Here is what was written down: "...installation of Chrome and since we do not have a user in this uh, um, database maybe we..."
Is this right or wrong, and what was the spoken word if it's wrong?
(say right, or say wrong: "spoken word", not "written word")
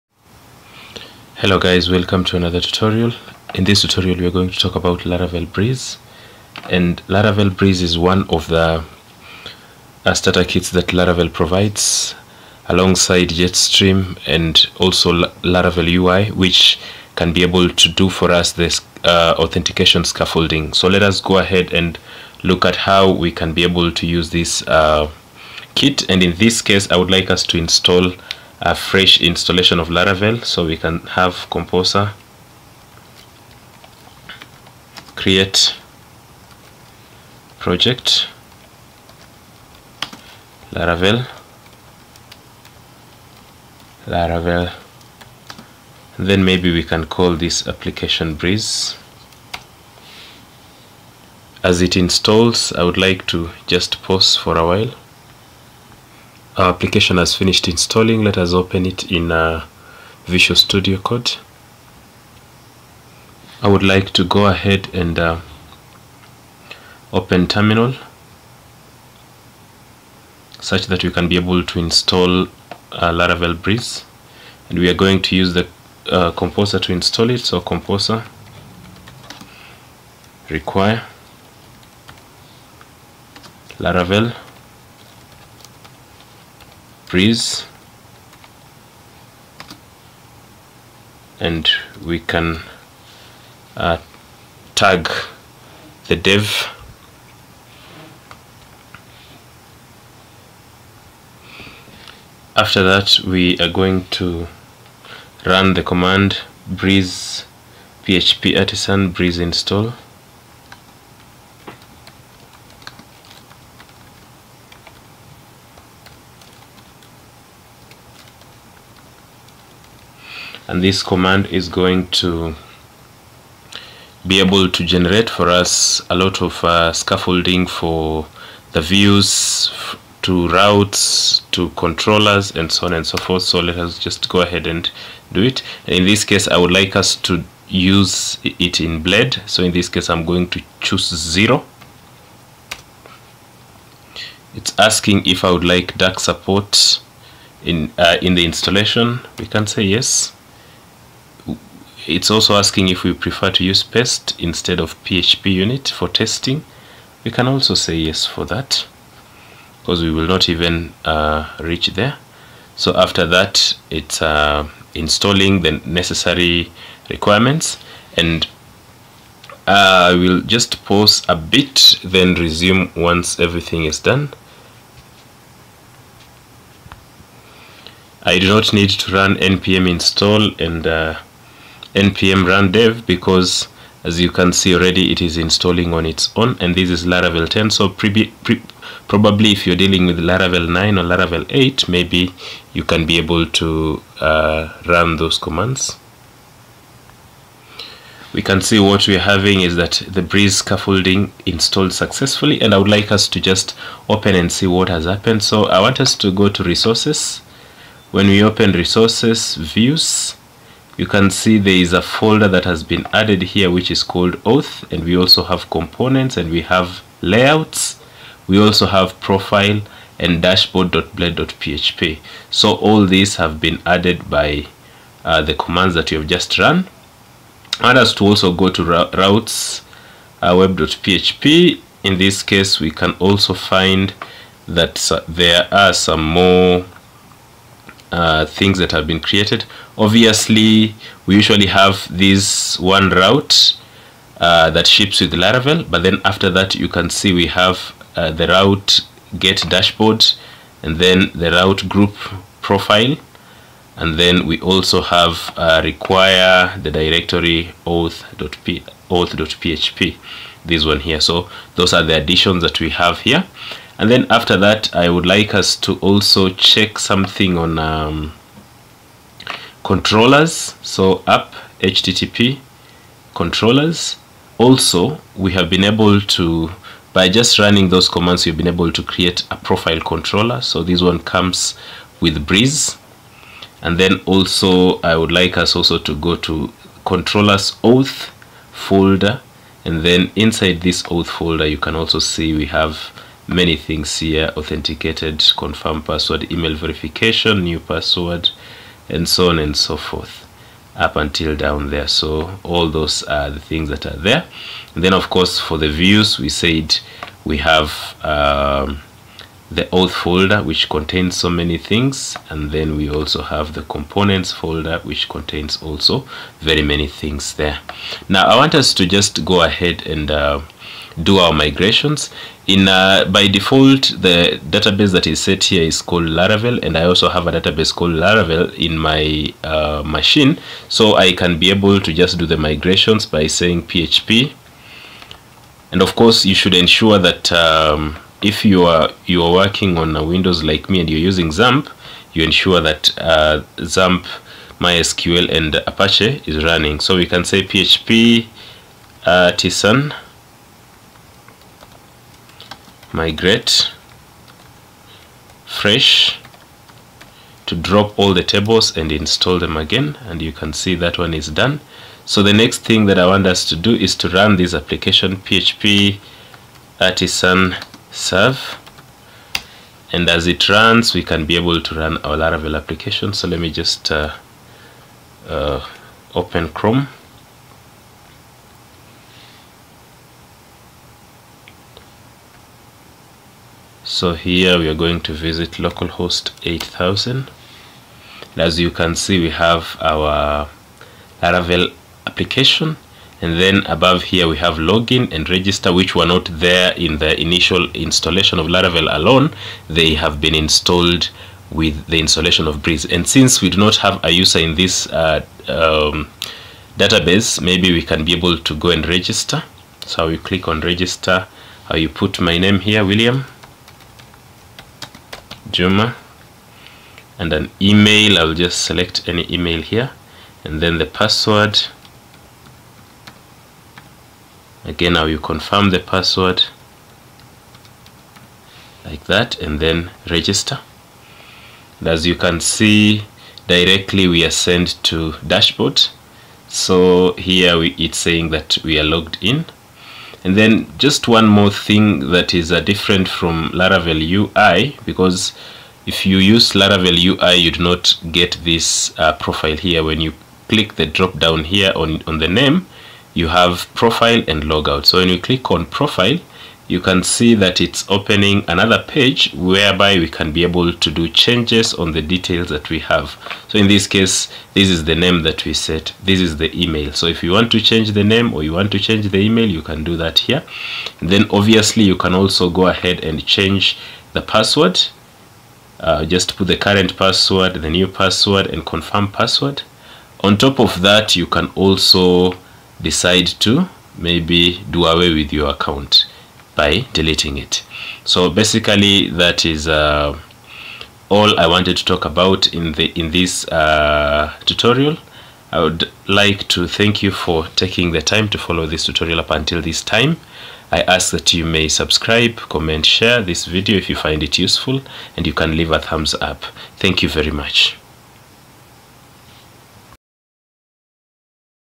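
wrong: "Breeze", not "Chrome".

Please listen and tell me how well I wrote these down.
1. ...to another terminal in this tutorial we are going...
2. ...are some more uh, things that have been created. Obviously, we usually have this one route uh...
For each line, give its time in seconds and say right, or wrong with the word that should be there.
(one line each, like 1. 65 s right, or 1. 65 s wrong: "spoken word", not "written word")
1. 2 s wrong: "tutorial", not "terminal"
2. 235 s right.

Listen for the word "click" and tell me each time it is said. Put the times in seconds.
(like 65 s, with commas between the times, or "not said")
410 s, 450 s, 455 s.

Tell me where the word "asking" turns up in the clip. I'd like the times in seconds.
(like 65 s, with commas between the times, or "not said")
144 s, 152 s.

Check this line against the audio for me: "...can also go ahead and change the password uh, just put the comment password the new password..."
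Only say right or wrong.
wrong.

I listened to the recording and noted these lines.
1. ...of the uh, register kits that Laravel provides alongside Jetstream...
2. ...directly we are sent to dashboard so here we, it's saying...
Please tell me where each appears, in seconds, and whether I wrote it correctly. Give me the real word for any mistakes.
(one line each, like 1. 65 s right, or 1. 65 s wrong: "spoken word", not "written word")
1. 8 s wrong: "starter", not "register"
2. 433 s right.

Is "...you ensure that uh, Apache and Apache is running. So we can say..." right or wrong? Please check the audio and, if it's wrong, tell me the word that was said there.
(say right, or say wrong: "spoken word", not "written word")
wrong: "MySQL", not "Apache".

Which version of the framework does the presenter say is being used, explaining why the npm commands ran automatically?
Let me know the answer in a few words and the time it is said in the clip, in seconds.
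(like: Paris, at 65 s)
Laravel 10, at 187 s.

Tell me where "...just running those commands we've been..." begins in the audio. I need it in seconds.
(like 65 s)
277 s.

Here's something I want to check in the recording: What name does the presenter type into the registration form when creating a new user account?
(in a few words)
William Juma.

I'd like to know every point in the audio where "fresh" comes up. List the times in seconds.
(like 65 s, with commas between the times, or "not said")
28 s, 355 s.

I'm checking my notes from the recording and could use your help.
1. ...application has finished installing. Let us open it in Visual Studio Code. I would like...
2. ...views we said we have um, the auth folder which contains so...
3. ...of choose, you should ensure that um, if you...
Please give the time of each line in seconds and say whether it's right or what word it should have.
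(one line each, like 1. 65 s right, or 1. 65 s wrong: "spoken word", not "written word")
1. 56 s right
2. 305 s right
3. 336 s wrong: "course", not "choose".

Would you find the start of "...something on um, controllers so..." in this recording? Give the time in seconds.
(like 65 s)
266 s.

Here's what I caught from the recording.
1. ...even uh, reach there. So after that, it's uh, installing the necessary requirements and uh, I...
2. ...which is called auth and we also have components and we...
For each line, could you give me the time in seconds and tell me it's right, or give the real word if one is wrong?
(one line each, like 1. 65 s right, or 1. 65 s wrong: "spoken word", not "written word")
1. 160 s right
2. 213 s right.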